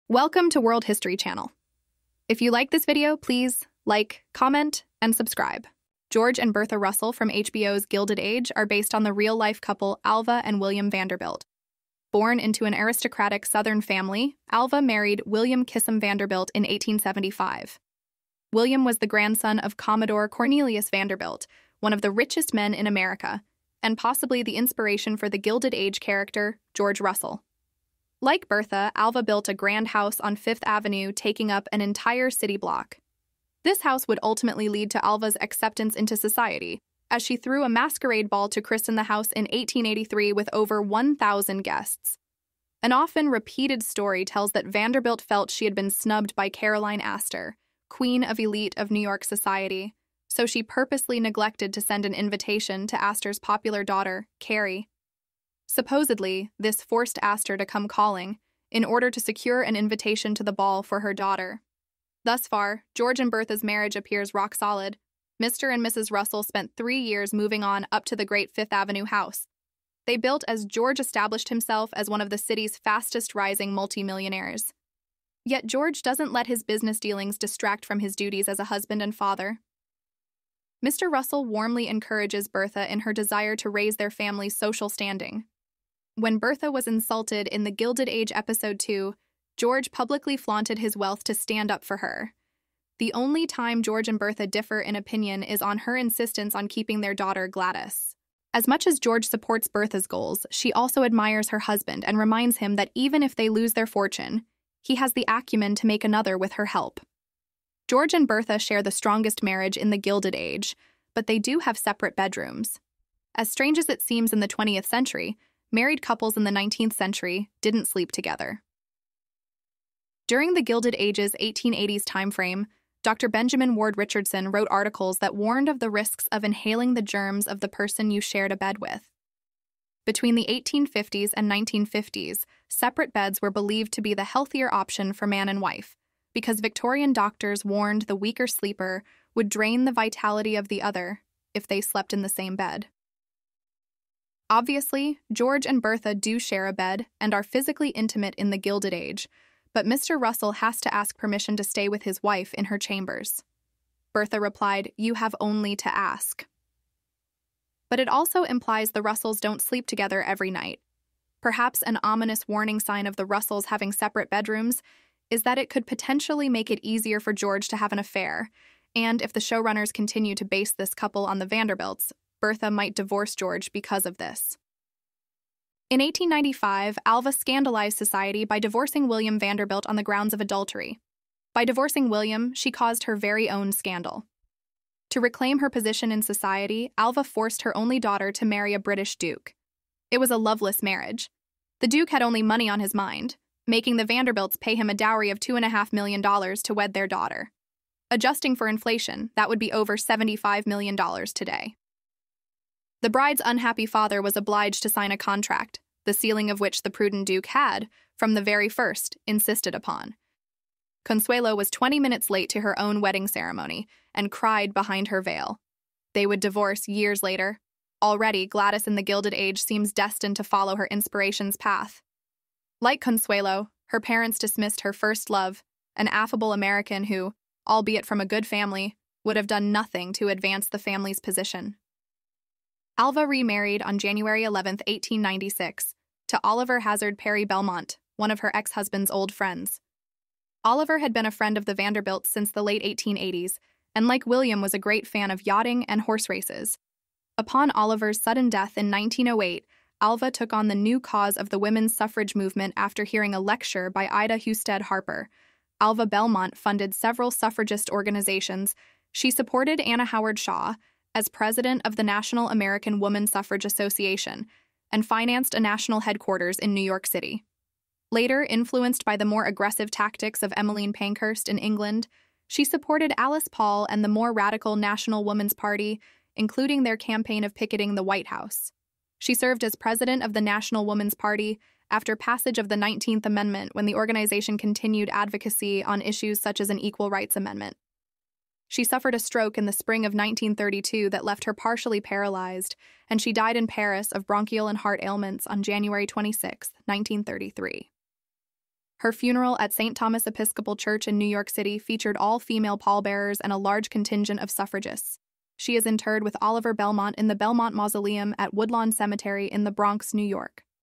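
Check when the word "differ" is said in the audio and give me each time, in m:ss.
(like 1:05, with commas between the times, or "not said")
1:34.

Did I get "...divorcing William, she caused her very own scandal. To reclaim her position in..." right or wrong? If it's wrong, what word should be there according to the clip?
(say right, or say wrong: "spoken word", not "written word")
right.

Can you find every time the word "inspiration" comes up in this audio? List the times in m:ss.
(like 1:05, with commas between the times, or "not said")
0:24, 3:40.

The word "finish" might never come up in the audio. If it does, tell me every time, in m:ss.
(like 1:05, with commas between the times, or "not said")
not said.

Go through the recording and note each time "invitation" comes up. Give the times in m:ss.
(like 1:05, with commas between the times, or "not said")
0:52, 0:59.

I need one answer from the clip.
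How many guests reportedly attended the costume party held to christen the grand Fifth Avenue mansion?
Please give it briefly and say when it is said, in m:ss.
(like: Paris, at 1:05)
over 1,000, at 0:40.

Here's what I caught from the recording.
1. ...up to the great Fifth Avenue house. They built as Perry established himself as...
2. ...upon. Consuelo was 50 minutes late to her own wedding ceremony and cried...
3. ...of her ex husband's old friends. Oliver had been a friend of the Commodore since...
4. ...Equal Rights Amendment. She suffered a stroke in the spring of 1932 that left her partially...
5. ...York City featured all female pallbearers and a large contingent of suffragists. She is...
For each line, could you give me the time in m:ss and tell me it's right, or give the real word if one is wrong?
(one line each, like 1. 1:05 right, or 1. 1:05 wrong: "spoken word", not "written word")
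1. 1:07 wrong: "George", not "Perry"
2. 3:29 wrong: "20", not "50"
3. 3:58 wrong: "Vanderbilts", not "Commodore"
4. 4:46 right
5. 5:01 right.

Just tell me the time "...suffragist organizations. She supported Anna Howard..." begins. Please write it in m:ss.
4:17.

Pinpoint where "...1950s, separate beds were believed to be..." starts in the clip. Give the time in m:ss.
2:11.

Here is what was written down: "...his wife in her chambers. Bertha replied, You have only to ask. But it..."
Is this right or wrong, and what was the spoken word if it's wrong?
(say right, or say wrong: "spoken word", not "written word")
right.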